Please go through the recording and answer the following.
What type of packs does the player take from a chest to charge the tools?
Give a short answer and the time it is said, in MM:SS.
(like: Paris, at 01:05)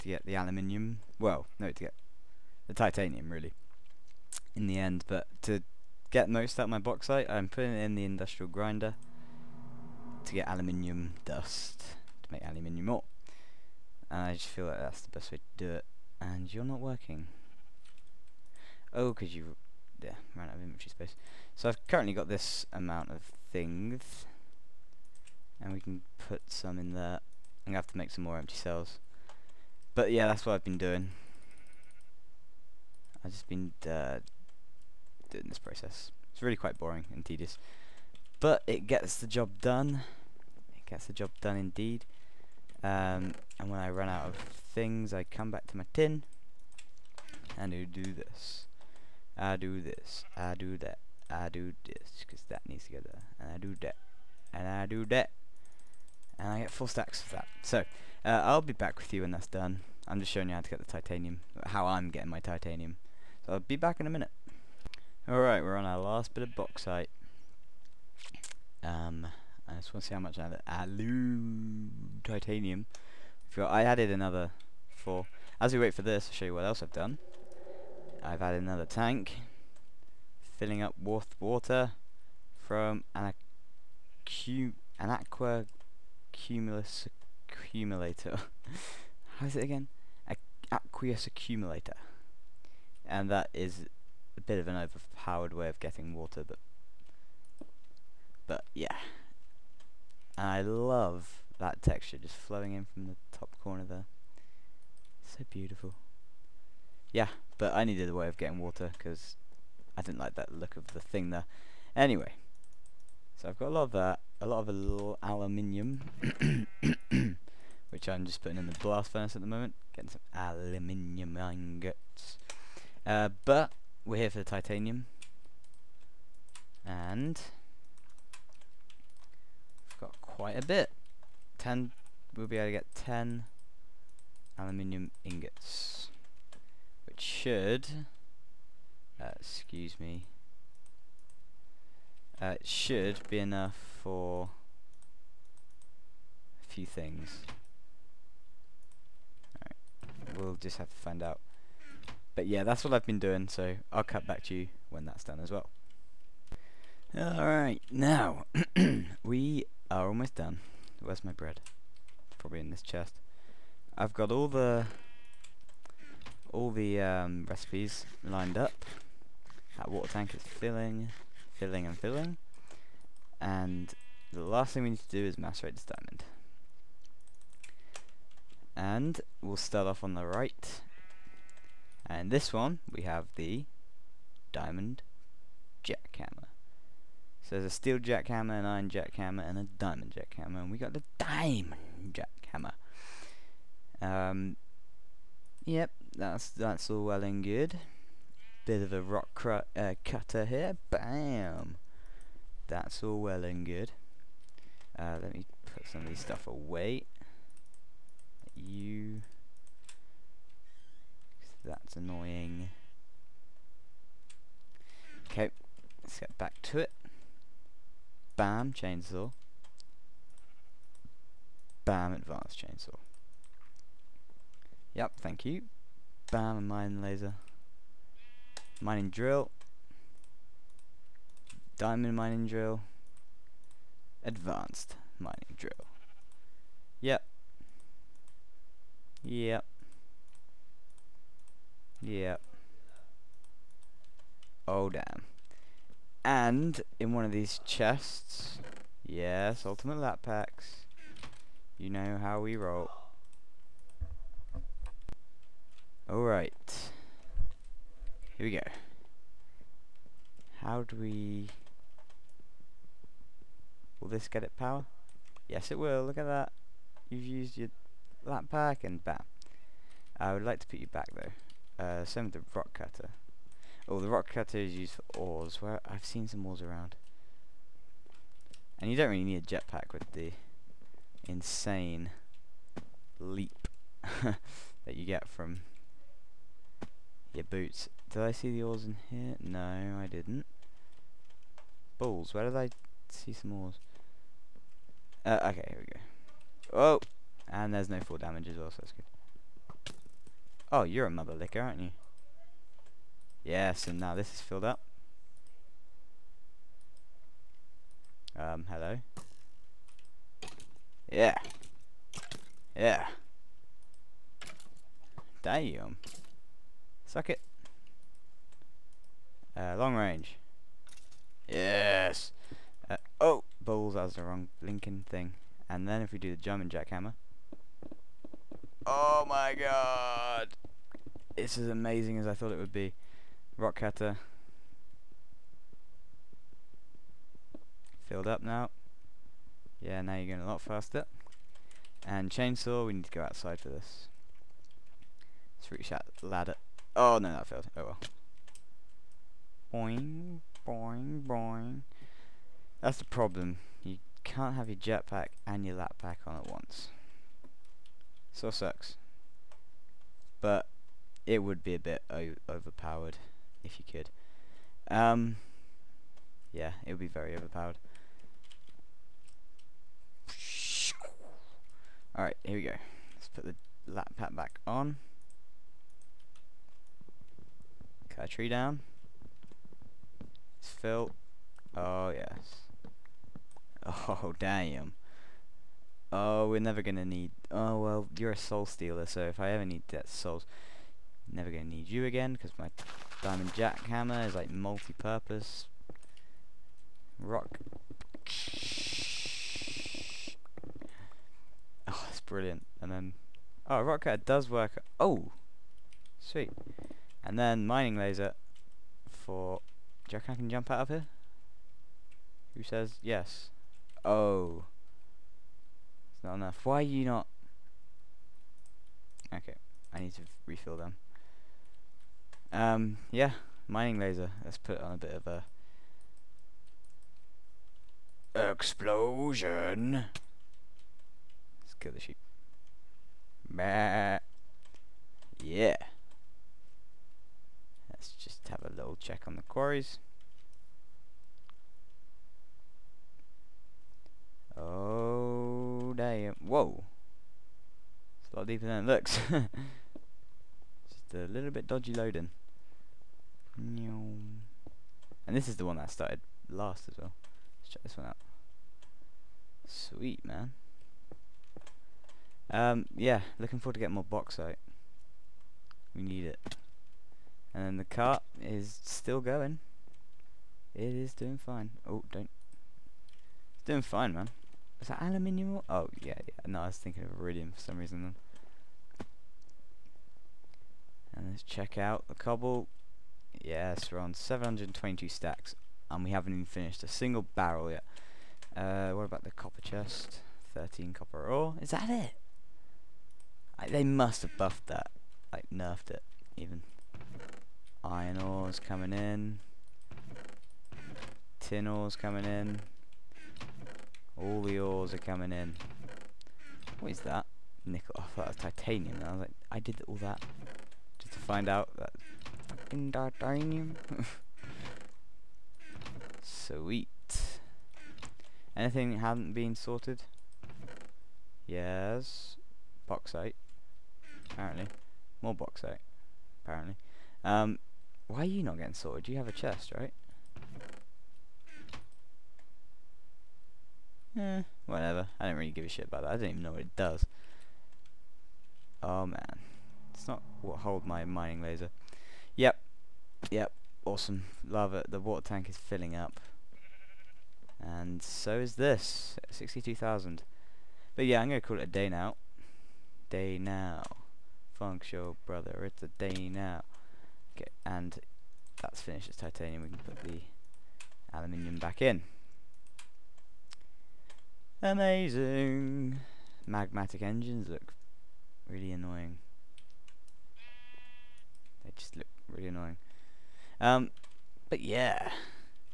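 Ultimate lap packs, at 04:09.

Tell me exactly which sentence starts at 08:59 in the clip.
It's not what hold my mining laser.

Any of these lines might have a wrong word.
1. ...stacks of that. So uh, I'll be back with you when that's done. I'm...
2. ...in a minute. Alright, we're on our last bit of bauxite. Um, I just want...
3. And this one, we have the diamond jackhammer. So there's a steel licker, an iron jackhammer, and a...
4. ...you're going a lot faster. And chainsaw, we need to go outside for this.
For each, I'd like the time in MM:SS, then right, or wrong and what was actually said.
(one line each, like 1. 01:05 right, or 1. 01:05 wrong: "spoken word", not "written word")
1. 00:56 right
2. 01:03 right
3. 03:02 wrong: "jackhammer", not "licker"
4. 05:40 right.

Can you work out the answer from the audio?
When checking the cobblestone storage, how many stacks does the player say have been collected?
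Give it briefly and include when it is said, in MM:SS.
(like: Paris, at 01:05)
722, at 08:04.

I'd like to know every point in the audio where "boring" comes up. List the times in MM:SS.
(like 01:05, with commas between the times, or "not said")
00:36.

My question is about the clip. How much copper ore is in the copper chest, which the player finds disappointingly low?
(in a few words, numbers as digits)
13.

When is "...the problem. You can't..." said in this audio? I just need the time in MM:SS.
05:52.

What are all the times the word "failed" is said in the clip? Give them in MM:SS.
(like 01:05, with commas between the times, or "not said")
05:47.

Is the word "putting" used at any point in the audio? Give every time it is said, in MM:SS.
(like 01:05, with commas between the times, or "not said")
00:07, 01:58.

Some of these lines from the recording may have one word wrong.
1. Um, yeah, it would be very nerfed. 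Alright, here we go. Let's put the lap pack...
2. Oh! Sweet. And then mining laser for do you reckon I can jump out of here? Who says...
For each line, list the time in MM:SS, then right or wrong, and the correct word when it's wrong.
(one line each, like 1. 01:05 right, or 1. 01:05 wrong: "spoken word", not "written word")
1. 06:04 wrong: "overpowered", not "nerfed"
2. 06:44 right.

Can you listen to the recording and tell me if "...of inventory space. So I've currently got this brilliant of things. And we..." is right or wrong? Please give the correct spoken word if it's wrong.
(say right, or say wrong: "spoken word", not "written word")
wrong: "amount", not "brilliant".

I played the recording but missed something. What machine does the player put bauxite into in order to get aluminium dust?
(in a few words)
Industrial grinder.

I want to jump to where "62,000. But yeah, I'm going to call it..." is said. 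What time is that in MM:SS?
09:09.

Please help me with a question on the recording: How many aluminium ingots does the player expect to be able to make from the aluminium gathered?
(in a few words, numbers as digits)
10.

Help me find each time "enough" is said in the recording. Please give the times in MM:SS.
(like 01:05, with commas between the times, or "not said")
02:23, 06:56.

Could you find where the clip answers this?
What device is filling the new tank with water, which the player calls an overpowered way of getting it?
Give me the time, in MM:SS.
01:30.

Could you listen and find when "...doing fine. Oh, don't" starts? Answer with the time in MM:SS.
07:51.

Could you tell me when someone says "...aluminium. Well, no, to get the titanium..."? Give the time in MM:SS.
00:00.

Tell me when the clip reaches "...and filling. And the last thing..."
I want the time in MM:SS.
02:51.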